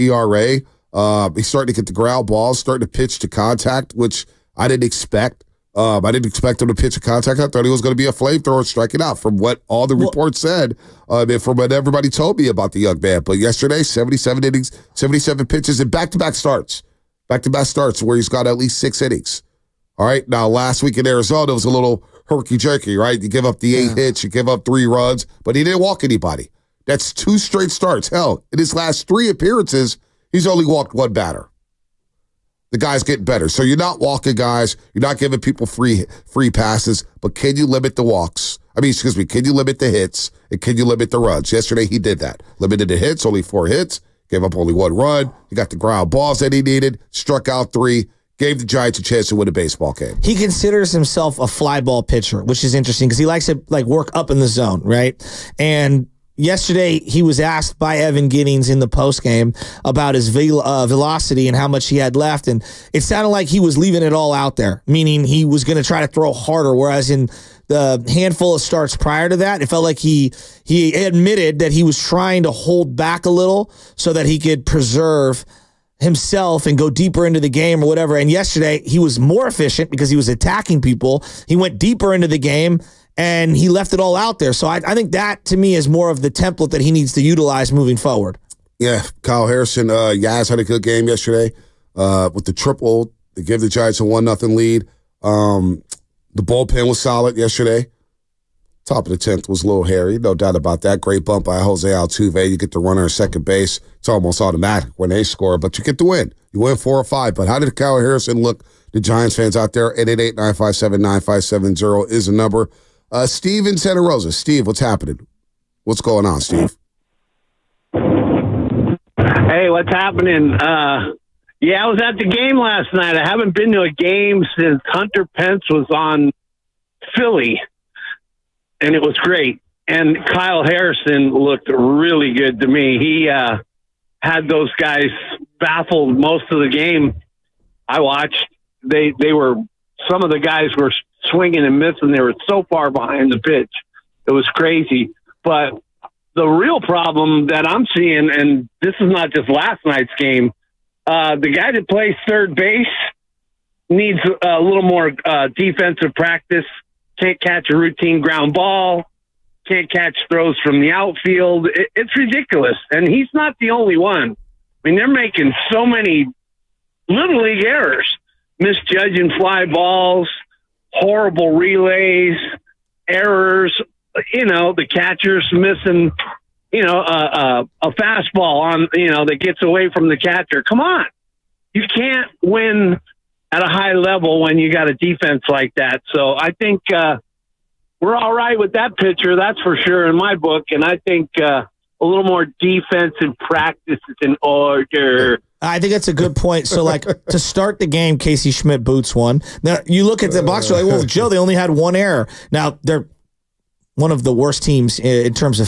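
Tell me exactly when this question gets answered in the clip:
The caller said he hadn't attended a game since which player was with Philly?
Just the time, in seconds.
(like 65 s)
124 s.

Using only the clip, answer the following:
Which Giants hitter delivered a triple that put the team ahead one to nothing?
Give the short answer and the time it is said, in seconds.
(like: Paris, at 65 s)
Yaz, at 90 s.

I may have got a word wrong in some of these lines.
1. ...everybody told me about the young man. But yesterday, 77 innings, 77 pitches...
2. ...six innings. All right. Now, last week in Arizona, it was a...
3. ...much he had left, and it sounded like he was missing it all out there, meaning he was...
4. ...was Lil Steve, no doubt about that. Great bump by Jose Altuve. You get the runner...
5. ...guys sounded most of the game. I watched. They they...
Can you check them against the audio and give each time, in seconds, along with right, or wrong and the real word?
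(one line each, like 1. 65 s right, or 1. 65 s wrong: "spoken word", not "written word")
1. 11 s right
2. 18 s right
3. 61 s wrong: "leaving", not "missing"
4. 99 s wrong: "Harry", not "Steve"
5. 134 s wrong: "baffled", not "sounded".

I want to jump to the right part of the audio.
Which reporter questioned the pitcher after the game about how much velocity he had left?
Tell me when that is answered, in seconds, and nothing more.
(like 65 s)
57 s.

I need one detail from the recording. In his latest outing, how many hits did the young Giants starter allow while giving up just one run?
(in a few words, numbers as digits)
4.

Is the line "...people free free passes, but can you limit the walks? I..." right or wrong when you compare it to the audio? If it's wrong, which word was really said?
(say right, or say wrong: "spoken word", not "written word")
right.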